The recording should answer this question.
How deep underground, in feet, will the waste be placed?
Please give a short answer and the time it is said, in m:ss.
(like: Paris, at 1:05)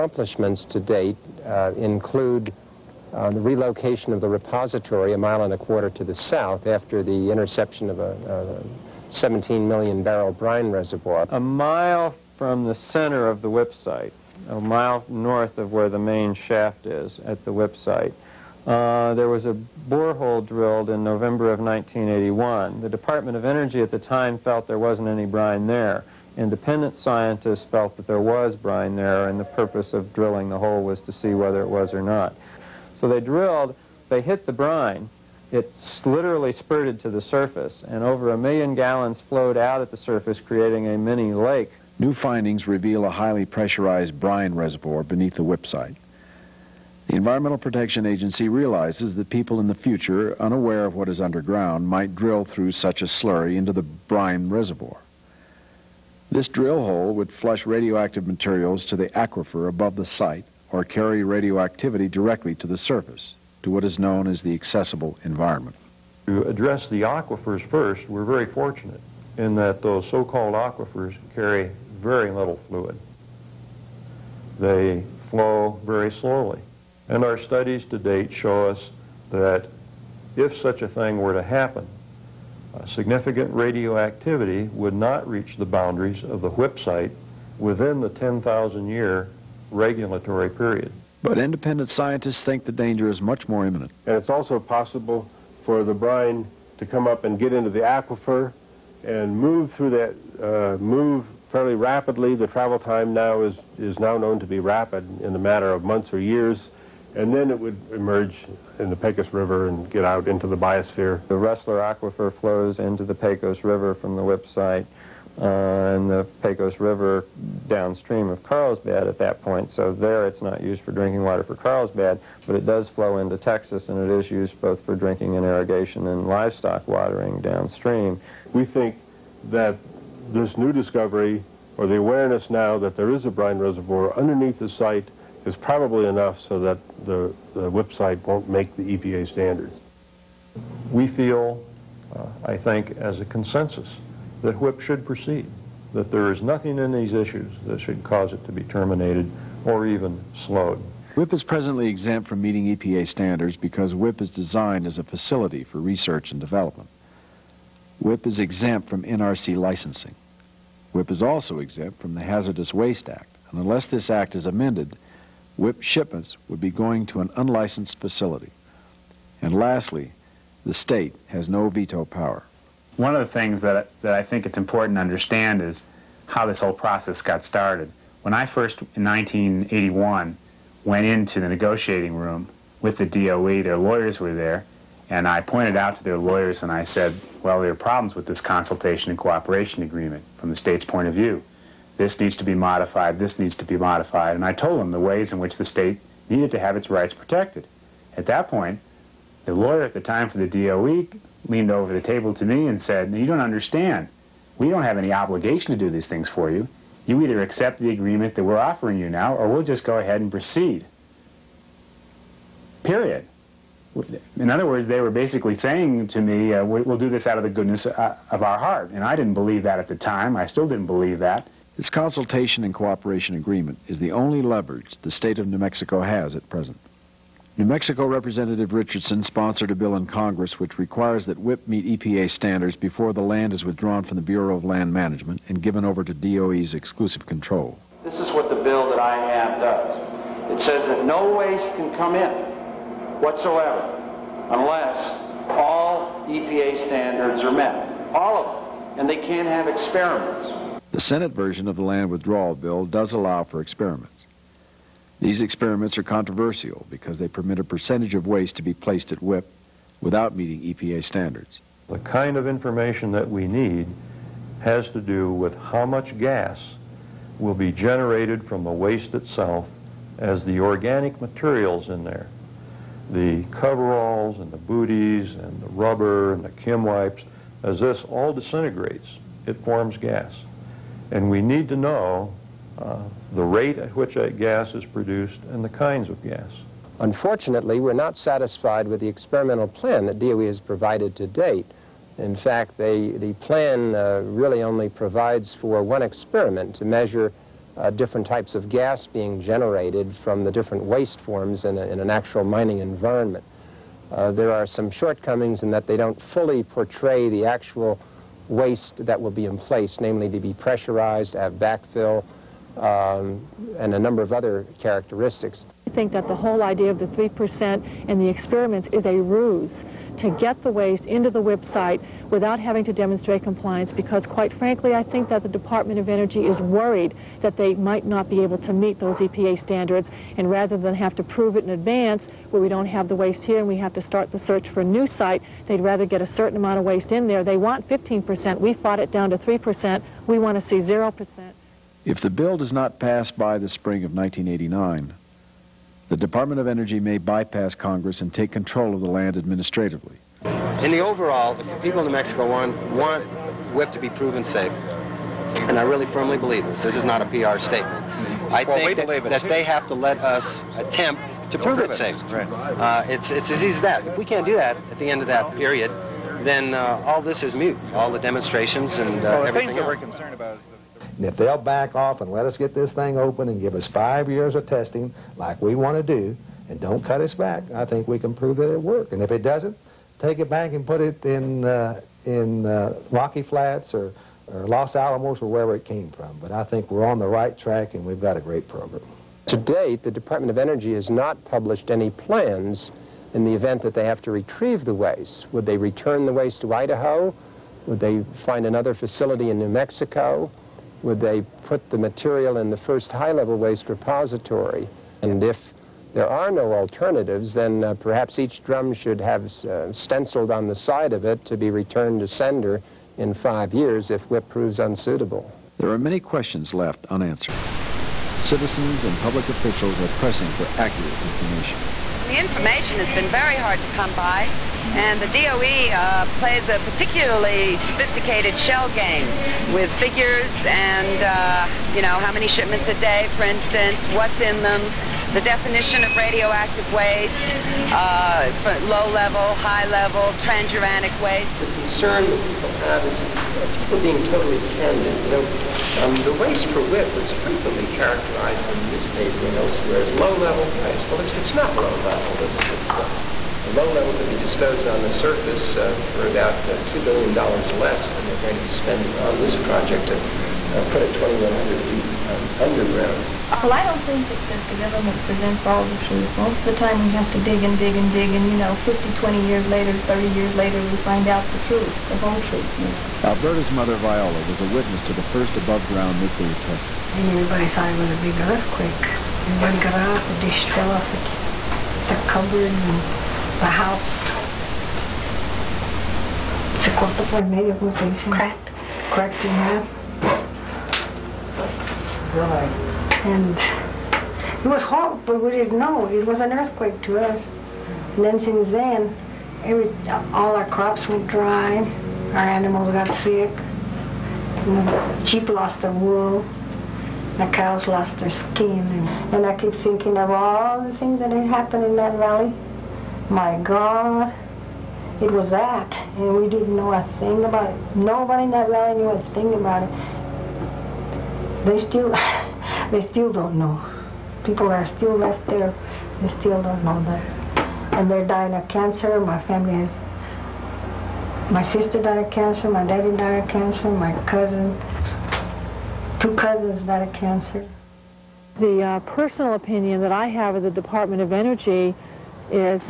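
2,100 feet, at 7:41.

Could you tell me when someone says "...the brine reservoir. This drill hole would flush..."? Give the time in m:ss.
0:53.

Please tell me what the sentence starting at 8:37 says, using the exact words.
Nobody in that valley knew a thing about it.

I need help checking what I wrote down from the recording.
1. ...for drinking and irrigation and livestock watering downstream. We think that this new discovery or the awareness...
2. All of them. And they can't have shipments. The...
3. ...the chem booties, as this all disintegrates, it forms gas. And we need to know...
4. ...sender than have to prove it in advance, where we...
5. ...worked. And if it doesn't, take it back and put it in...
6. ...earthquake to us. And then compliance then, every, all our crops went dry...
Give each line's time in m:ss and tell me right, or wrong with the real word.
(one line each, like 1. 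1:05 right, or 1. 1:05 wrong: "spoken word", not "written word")
1. 2:04 right
2. 4:08 wrong: "experiments", not "shipments"
3. 4:36 wrong: "wipes", not "booties"
4. 5:30 wrong: "rather", not "sender"
5. 6:18 right
6. 8:16 wrong: "since", not "compliance".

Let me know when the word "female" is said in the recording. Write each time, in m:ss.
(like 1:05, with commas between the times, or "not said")
not said.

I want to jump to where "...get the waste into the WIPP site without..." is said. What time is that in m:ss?
5:20.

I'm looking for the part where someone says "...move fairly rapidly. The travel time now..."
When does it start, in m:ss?
1:40.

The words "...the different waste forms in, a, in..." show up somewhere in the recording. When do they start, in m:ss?
5:00.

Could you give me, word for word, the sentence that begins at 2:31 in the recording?
WIPP is presently exempt from meeting EPA standards because WIPP is designed as a facility for research and development.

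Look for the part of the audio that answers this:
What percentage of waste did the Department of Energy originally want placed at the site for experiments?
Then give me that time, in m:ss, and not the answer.
5:37.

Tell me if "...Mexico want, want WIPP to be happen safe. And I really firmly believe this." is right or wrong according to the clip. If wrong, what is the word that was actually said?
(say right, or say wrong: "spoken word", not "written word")
wrong: "proven", not "happen".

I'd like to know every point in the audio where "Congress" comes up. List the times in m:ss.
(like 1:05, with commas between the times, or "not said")
3:50, 5:47.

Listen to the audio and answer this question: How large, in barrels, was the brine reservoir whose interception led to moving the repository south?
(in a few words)
17 million barrels.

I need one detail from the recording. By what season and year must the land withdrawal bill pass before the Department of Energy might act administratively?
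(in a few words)
spring of 1989.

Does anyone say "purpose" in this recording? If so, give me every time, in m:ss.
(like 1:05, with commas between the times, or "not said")
0:29.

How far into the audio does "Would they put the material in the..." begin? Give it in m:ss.
6:41.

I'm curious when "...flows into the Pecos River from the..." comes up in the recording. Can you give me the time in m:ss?
1:52.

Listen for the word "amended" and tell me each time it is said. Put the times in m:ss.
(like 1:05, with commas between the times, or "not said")
2:44.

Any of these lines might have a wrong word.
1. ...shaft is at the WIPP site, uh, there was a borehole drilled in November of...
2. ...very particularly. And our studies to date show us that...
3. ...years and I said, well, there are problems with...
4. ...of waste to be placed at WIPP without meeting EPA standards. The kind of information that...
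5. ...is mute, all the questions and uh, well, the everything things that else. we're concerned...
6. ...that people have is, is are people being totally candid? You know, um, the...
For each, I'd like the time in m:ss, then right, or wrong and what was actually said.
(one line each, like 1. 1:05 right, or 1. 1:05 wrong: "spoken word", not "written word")
1. 0:16 right
2. 1:15 wrong: "slowly", not "particularly"
3. 3:06 wrong: "lawyers", not "years"
4. 4:18 right
5. 6:07 wrong: "demonstrations", not "questions"
6. 7:22 right.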